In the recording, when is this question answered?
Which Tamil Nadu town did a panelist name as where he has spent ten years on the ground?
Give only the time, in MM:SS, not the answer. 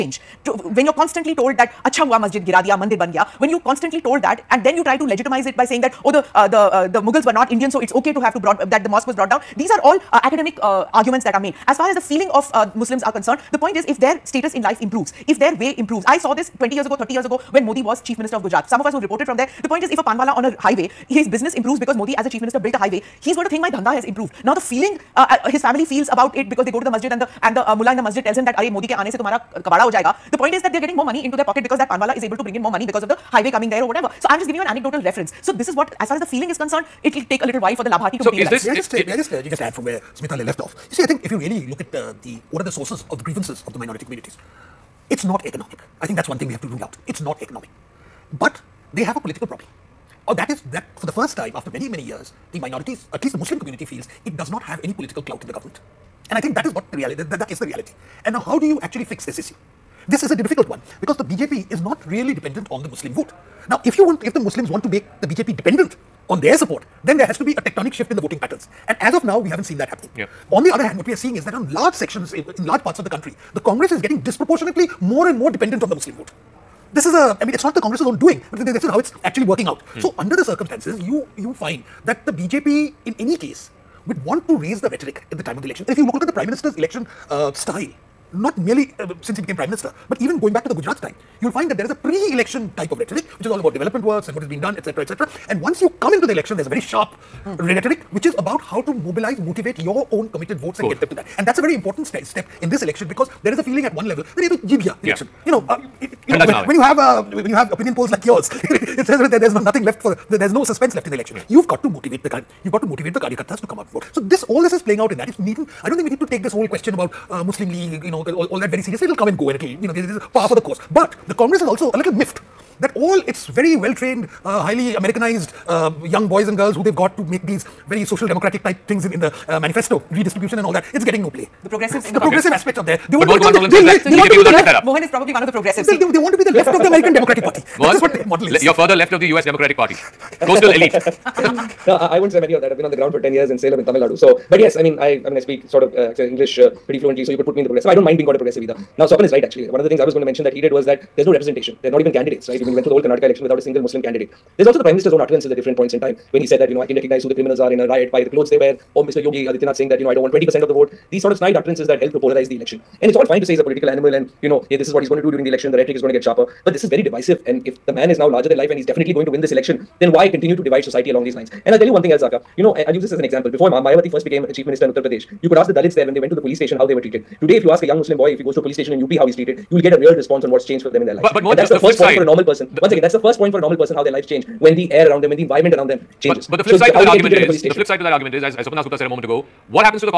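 02:23.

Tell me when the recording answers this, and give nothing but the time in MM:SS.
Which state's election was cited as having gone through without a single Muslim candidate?
02:33.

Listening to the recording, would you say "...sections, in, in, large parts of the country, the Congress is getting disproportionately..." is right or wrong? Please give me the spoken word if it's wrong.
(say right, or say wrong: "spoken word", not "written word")
right.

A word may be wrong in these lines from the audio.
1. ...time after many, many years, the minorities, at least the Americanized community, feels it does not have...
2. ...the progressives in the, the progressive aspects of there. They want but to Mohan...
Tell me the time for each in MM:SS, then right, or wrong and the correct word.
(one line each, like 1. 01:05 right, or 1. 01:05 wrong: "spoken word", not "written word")
1. 00:51 wrong: "Muslim", not "Americanized"
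2. 02:11 right.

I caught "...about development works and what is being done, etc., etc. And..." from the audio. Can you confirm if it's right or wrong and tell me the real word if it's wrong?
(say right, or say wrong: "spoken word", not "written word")
right.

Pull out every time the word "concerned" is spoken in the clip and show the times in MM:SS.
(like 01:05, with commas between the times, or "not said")
00:13, 00:36.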